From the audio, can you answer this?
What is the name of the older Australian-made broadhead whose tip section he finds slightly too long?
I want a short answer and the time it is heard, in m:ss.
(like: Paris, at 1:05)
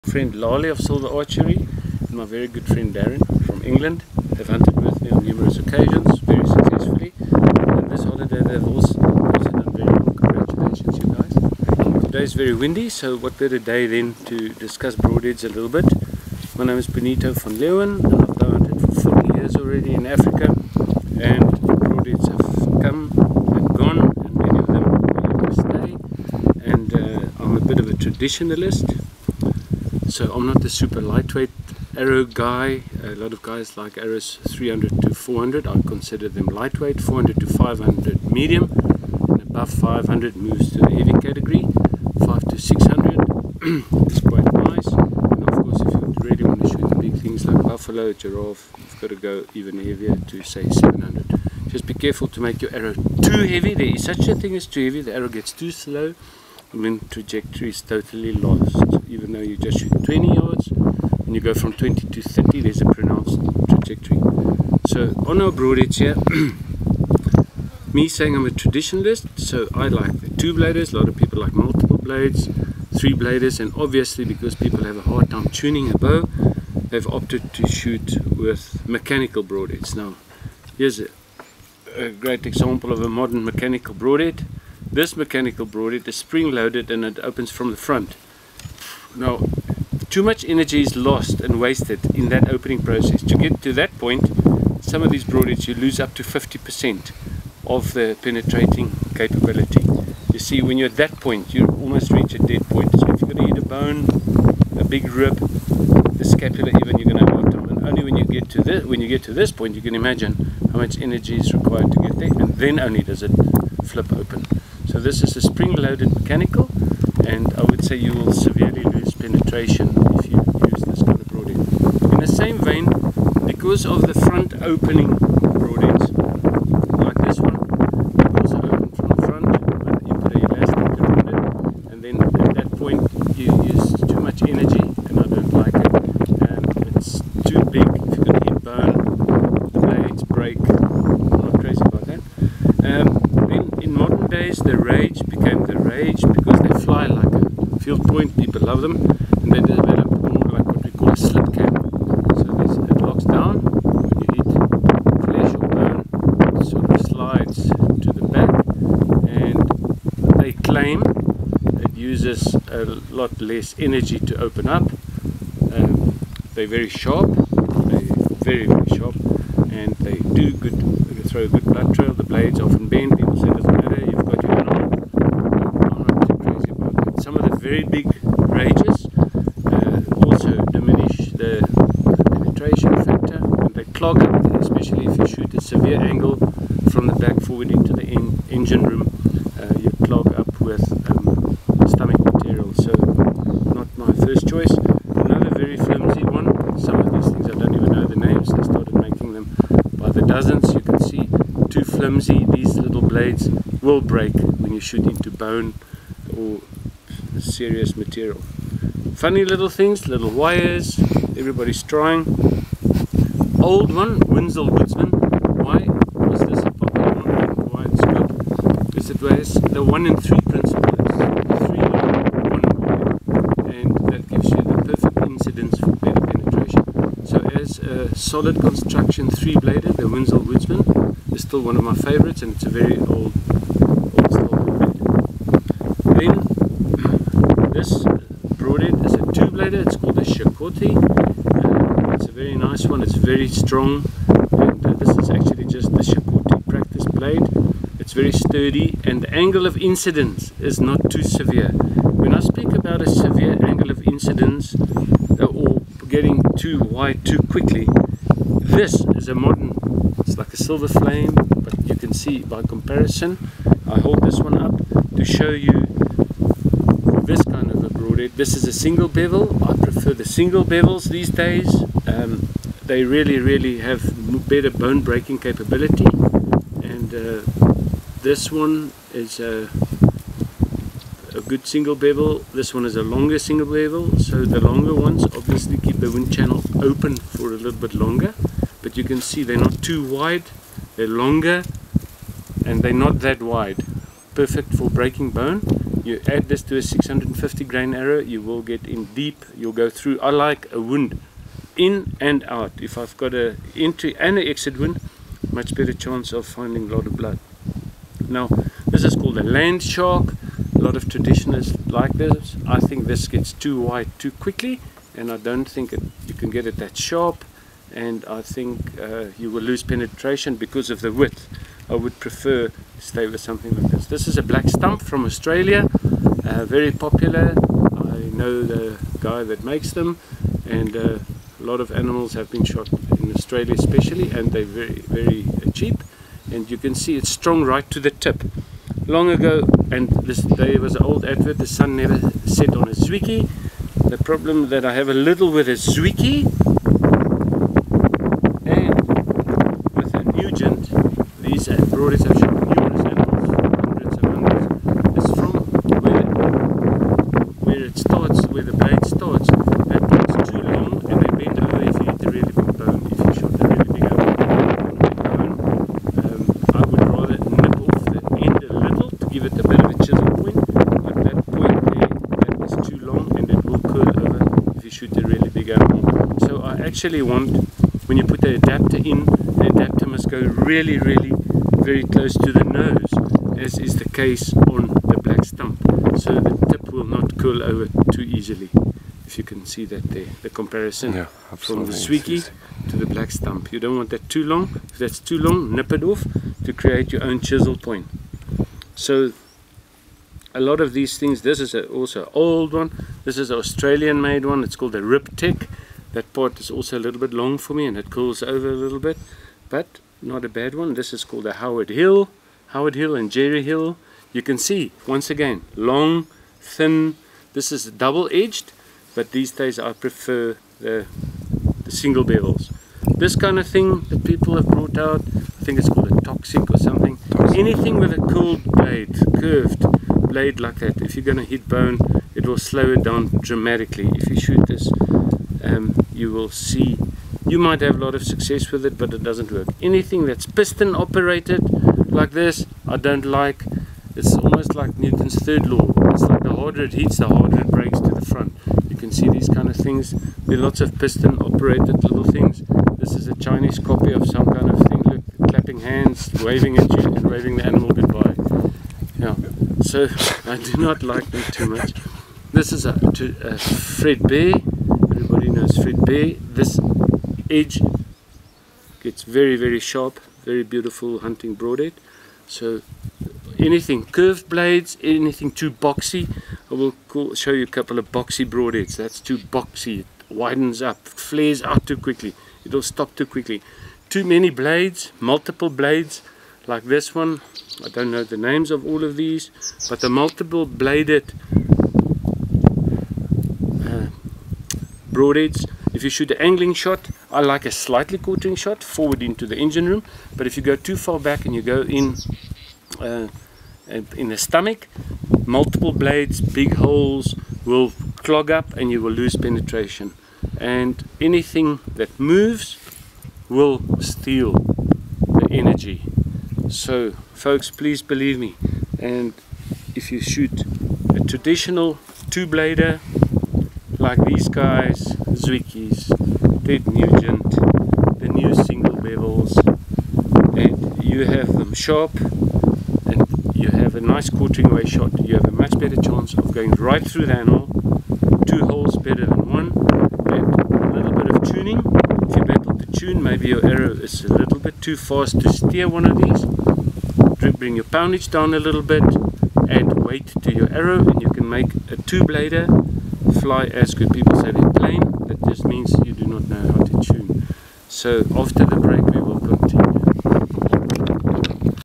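Rip Tech, at 6:45.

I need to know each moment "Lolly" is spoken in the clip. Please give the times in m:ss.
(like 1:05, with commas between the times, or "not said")
0:00.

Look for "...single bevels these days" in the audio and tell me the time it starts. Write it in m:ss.
4:30.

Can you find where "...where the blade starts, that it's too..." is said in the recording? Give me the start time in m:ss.
5:58.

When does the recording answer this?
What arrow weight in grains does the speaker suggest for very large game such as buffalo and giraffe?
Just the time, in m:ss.
0:50.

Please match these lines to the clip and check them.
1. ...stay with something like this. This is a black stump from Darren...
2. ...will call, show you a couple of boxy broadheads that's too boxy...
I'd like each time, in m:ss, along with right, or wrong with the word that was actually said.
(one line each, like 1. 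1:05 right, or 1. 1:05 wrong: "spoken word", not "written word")
1. 5:23 wrong: "Australia", not "Darren"
2. 7:56 right.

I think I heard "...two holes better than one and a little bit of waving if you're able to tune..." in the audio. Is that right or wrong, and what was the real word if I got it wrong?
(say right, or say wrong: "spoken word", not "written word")
wrong: "tuning", not "waving".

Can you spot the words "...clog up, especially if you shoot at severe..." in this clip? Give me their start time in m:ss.
3:03.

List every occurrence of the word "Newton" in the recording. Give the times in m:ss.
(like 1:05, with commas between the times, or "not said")
7:24.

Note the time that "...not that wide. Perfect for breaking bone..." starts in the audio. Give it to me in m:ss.
4:52.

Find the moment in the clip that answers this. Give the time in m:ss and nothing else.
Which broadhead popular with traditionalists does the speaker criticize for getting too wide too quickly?
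5:09.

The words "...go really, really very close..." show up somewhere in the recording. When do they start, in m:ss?
6:20.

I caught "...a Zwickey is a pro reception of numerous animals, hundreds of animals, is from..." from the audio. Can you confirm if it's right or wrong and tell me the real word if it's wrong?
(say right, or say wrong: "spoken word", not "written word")
right.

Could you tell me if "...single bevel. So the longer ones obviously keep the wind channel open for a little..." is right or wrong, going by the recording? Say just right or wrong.
right.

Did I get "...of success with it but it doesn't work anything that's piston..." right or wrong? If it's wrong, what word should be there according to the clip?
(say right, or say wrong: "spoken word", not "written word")
right.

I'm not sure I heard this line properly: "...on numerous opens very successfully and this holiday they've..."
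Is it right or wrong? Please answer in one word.
wrong.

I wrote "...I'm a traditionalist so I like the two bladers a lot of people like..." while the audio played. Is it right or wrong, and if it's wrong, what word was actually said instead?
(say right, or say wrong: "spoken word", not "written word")
right.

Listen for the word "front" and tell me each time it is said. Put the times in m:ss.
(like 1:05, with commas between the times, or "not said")
1:27, 2:04, 2:09, 7:28.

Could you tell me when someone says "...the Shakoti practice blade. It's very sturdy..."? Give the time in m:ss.
4:05.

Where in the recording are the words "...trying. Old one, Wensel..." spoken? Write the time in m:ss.
3:31.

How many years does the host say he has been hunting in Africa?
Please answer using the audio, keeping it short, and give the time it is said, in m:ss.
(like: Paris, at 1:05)
40, at 0:19.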